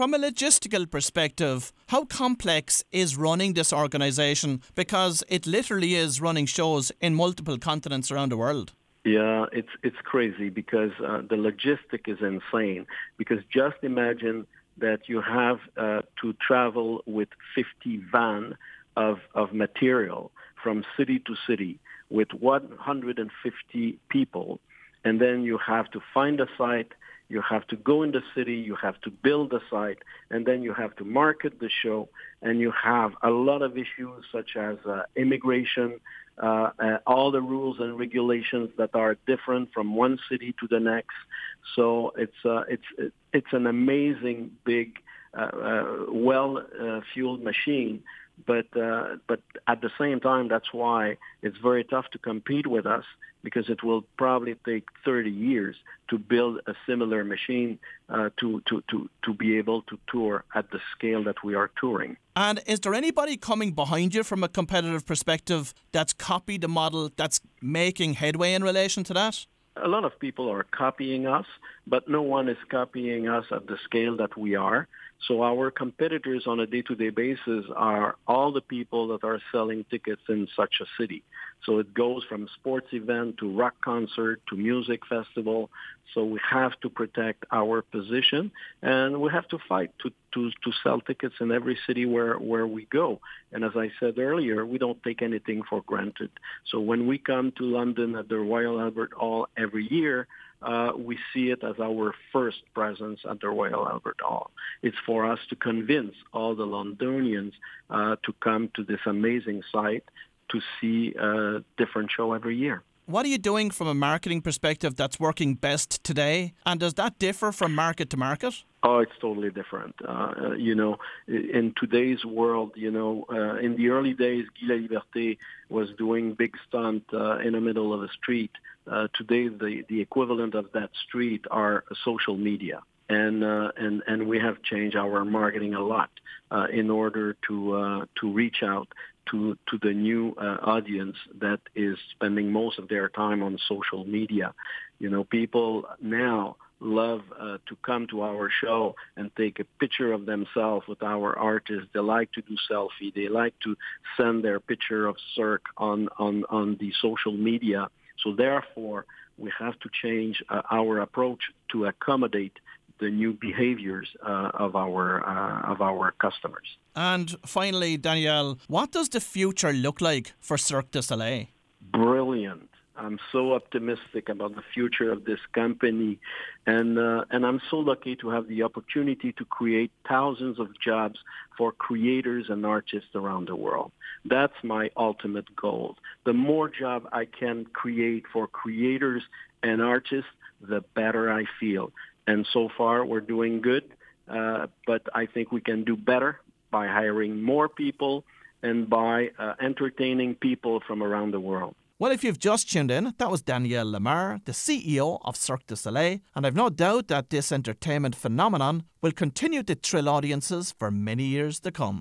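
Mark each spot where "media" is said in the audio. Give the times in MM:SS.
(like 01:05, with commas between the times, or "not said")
02:12, 02:24, 02:37.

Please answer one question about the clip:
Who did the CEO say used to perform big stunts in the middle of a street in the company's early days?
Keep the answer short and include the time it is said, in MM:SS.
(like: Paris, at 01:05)
Guy Laliberté, at 02:04.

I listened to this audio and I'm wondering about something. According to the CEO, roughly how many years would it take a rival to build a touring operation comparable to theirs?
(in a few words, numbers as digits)
30 years.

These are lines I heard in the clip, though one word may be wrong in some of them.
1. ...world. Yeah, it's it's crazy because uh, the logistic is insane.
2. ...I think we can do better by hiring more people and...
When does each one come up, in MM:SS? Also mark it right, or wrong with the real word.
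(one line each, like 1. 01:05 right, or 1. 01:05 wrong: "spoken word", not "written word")
1. 00:08 right
2. 03:15 right.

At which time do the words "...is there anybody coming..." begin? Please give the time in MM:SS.
01:02.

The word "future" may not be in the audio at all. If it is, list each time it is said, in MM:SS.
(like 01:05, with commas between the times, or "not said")
02:49, 02:54.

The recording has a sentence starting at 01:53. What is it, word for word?
What are you doing from a marketing perspective that's working best today?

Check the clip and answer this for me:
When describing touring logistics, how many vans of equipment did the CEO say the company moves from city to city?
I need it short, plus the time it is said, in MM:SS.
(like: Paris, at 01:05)
50, at 00:17.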